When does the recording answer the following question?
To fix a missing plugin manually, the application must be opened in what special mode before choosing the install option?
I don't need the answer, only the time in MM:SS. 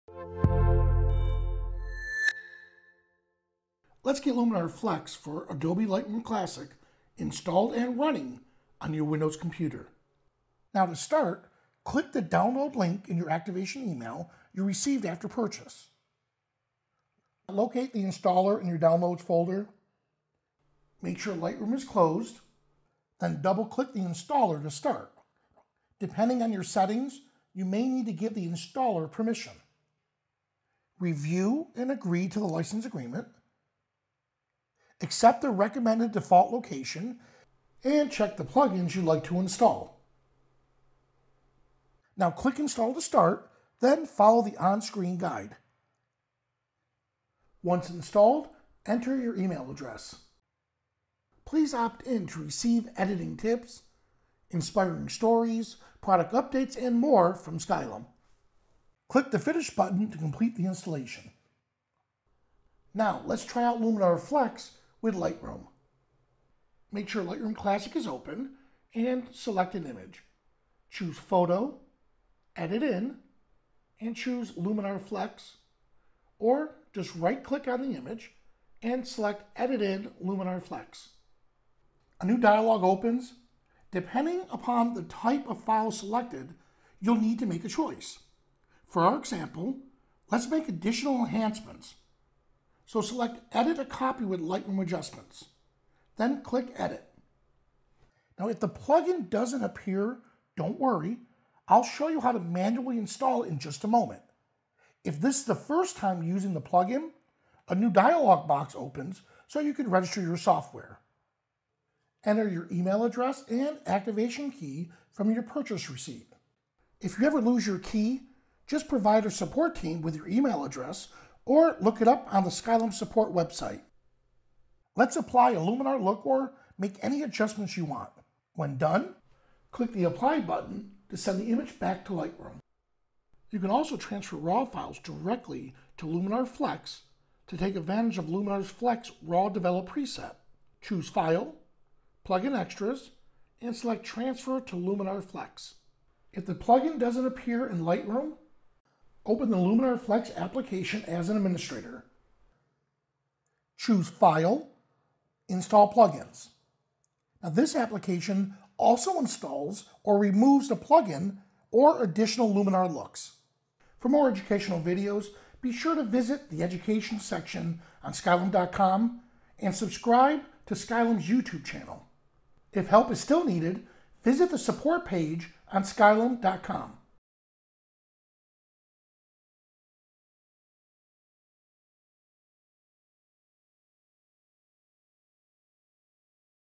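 02:31.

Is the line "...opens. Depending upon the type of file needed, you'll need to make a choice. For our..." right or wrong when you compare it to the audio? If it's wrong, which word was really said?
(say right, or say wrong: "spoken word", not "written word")
wrong: "selected", not "needed".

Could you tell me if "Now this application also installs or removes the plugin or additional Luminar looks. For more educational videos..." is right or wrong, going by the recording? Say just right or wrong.
right.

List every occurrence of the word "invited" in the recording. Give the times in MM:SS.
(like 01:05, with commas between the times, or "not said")
not said.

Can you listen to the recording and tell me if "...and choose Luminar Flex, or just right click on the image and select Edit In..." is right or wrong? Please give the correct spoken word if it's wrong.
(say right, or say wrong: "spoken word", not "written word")
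right.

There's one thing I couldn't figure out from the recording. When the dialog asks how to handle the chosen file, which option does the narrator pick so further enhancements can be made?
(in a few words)
Edit a copy with Lightroom adjustments.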